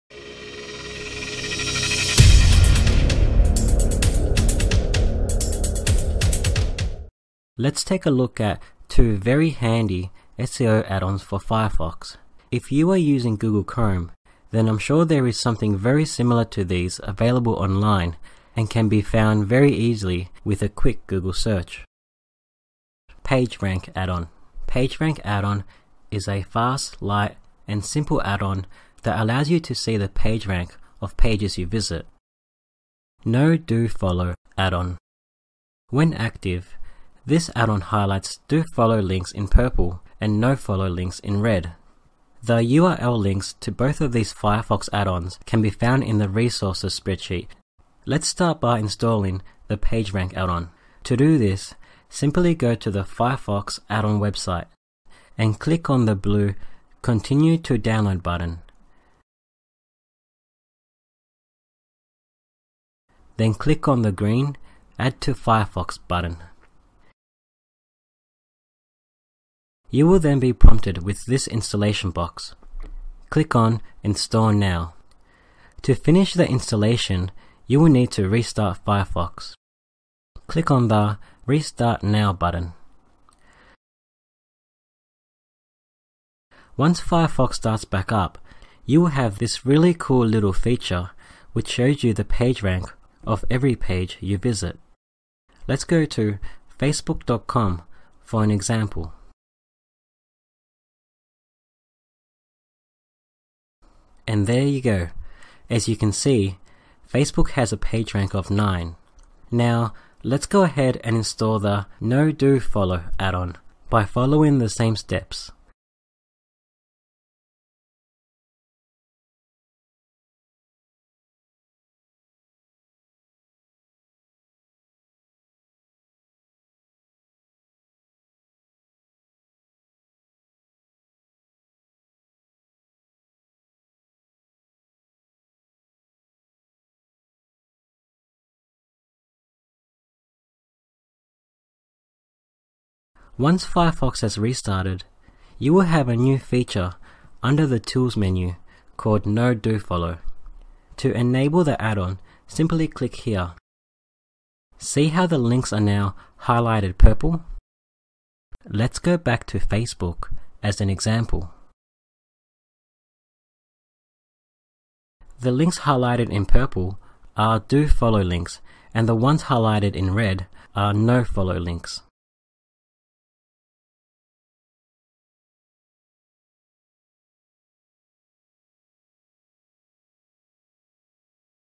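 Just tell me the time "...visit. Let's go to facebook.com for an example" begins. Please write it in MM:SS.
01:34.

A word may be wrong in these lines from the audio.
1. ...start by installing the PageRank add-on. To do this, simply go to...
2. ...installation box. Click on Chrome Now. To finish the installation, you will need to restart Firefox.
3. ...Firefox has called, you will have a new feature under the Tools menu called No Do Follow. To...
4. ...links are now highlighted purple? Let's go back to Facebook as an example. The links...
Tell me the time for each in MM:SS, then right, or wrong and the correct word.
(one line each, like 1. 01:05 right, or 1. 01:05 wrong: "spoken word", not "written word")
1. 00:48 right
2. 01:11 wrong: "Install", not "Chrome"
3. 02:23 wrong: "restarted", not "called"
4. 02:35 right.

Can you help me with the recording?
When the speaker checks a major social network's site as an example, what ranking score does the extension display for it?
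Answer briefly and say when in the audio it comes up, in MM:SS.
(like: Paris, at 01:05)
9, at 01:47.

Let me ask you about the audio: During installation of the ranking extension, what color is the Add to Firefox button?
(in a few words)
green.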